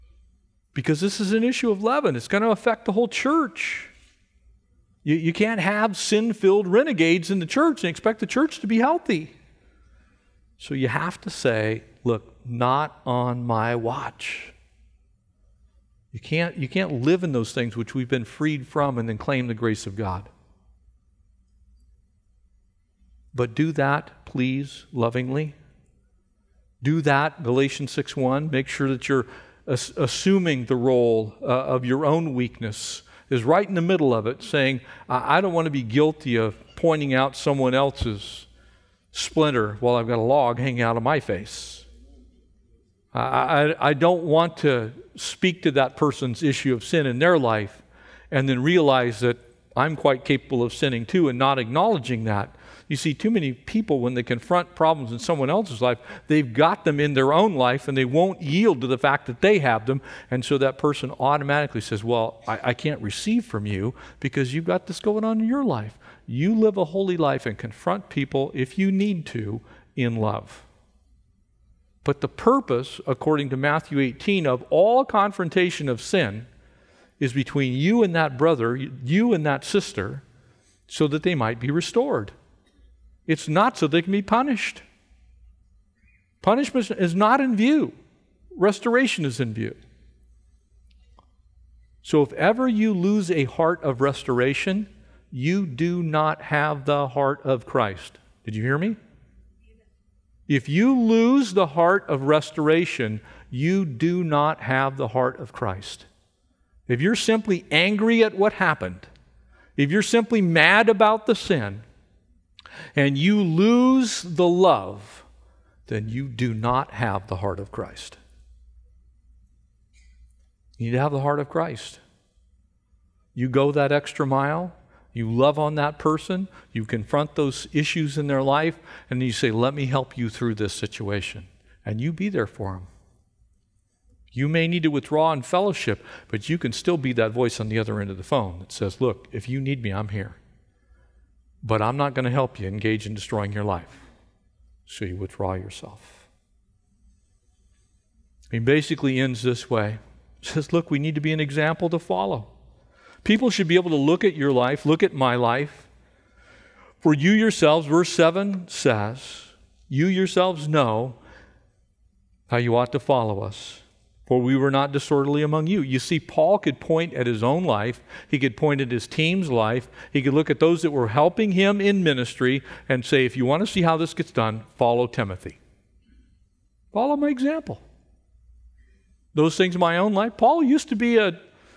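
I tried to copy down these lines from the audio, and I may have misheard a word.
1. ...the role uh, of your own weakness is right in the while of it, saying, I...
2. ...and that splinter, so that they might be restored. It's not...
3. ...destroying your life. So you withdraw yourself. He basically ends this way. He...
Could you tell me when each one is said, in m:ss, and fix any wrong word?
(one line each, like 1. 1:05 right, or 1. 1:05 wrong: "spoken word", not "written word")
1. 0:30 wrong: "middle", not "while"
2. 1:19 wrong: "sister", not "splinter"
3. 2:23 right.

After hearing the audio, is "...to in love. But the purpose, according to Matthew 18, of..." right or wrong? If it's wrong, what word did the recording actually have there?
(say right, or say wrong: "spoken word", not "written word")
right.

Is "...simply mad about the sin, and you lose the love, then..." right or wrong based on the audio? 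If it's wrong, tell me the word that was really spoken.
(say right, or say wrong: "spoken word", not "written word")
right.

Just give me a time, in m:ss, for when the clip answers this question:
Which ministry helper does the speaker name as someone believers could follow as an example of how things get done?
2:55.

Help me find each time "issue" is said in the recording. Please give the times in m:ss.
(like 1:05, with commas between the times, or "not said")
0:01, 0:46, 2:07.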